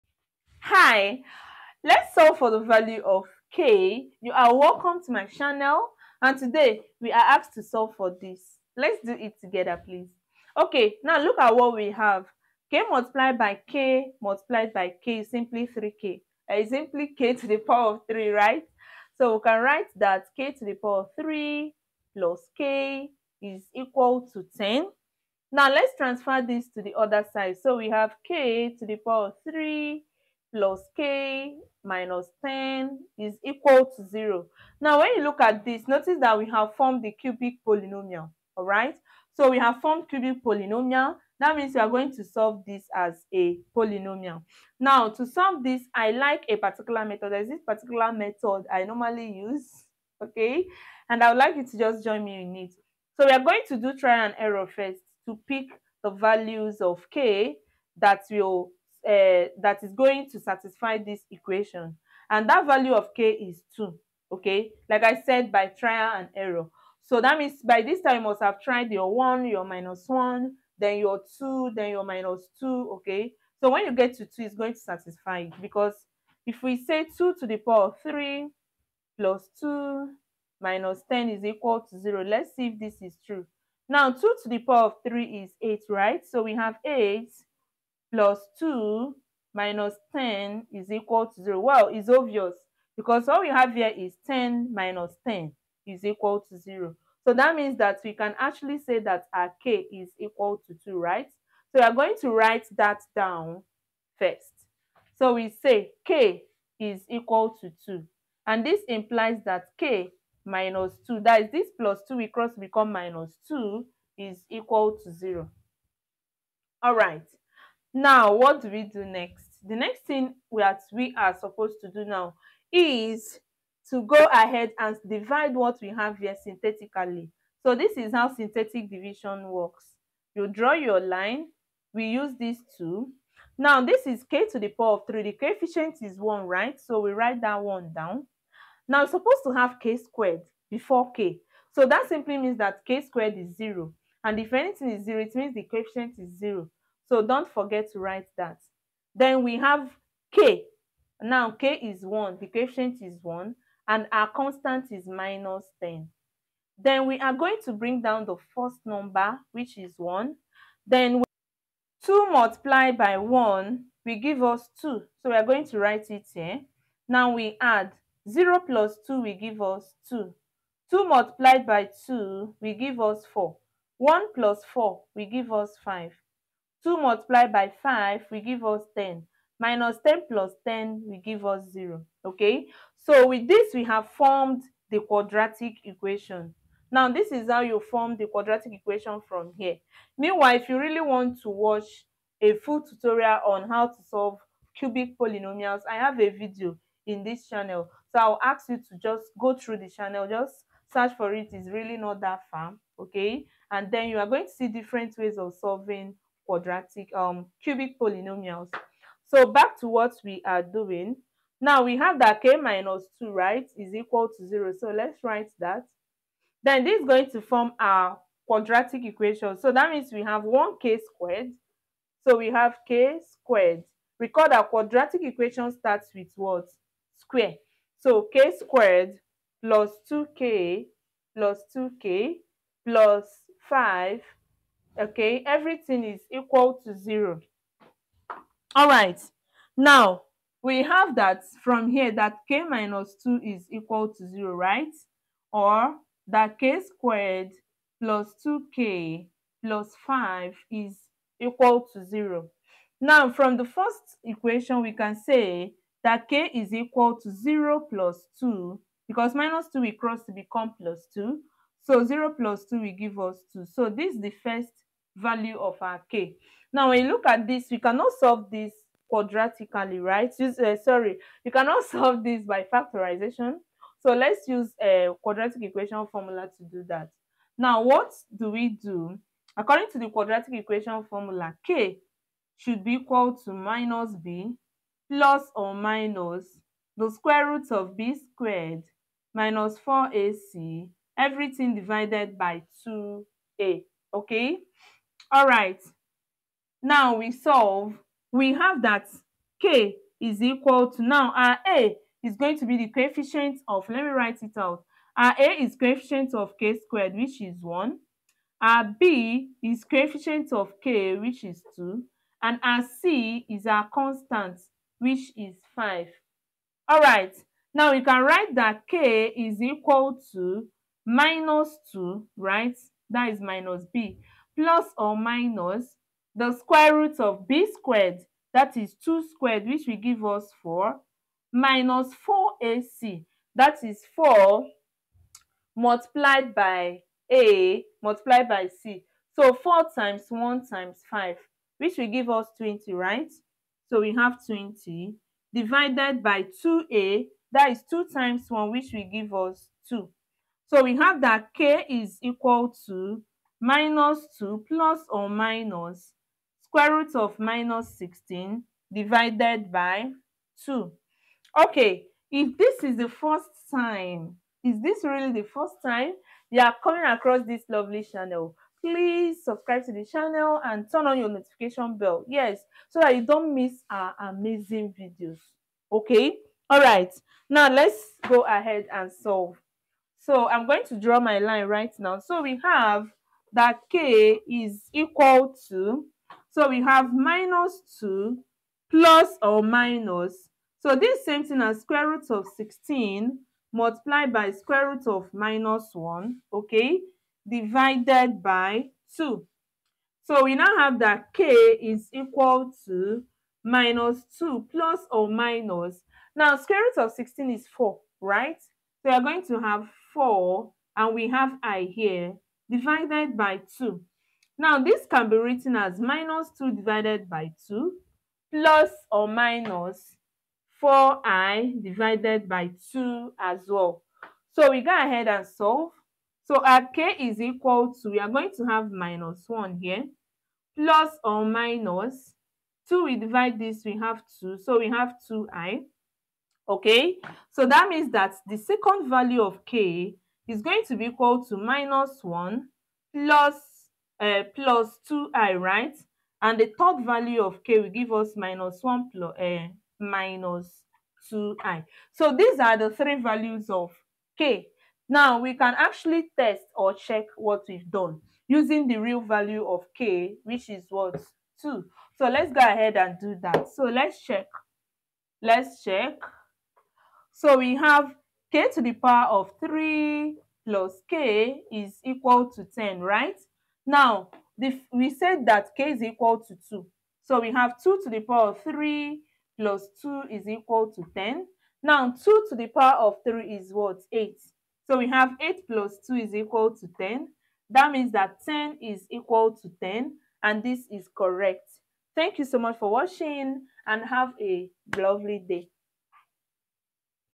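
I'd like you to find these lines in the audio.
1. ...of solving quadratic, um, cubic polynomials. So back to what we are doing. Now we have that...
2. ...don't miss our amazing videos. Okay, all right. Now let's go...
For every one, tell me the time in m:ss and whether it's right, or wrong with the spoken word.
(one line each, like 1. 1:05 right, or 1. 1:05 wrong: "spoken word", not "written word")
1. 3:25 right
2. 6:13 right.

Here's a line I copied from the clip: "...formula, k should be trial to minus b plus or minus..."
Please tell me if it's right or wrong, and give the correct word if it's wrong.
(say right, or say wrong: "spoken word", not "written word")
wrong: "equal", not "trial".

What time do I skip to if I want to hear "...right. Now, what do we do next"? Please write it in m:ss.
1:56.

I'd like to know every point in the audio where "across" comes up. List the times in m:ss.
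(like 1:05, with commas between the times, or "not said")
6:07.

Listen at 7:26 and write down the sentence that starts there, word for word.
And the third value of k will give us minus 1 plus, uh, eh, minus 2i.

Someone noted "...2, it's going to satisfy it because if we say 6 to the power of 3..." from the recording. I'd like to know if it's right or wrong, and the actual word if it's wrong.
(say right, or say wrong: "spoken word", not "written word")
wrong: "2", not "6".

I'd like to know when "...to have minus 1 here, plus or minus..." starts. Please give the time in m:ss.
7:08.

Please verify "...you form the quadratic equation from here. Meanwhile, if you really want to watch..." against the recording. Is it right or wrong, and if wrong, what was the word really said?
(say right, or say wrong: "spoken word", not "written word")
right.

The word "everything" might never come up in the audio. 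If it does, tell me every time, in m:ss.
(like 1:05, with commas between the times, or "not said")
3:55, 4:51.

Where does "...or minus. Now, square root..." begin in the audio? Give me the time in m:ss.
6:45.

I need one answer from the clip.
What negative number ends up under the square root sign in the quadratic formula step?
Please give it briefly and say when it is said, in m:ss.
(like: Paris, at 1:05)
-16, at 5:57.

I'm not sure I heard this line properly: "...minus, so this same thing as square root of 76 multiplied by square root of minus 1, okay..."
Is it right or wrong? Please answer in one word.
wrong.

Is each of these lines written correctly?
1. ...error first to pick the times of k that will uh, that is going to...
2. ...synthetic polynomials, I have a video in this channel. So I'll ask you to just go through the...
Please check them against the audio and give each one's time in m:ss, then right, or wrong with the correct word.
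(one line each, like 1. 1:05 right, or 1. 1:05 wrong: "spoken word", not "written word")
1. 0:54 wrong: "values", not "times"
2. 3:14 wrong: "cubic", not "synthetic".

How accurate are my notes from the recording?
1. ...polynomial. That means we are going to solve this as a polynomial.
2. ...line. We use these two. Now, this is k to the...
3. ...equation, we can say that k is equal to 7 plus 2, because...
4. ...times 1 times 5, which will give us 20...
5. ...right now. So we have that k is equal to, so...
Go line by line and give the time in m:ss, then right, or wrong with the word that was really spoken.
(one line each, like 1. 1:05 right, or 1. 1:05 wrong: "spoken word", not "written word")
1. 0:40 right
2. 2:11 right
3. 4:14 wrong: "0", not "7"
4. 5:39 right
5. 6:21 right.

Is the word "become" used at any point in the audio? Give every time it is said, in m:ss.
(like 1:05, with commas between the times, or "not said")
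1:52, 4:20.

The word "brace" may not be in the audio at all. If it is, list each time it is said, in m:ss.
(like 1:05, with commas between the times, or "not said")
not said.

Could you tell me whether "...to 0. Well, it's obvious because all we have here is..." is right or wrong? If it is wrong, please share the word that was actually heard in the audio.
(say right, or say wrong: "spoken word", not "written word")
right.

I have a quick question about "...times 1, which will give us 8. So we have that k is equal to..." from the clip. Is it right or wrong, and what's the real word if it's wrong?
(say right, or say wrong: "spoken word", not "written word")
wrong: "2", not "8".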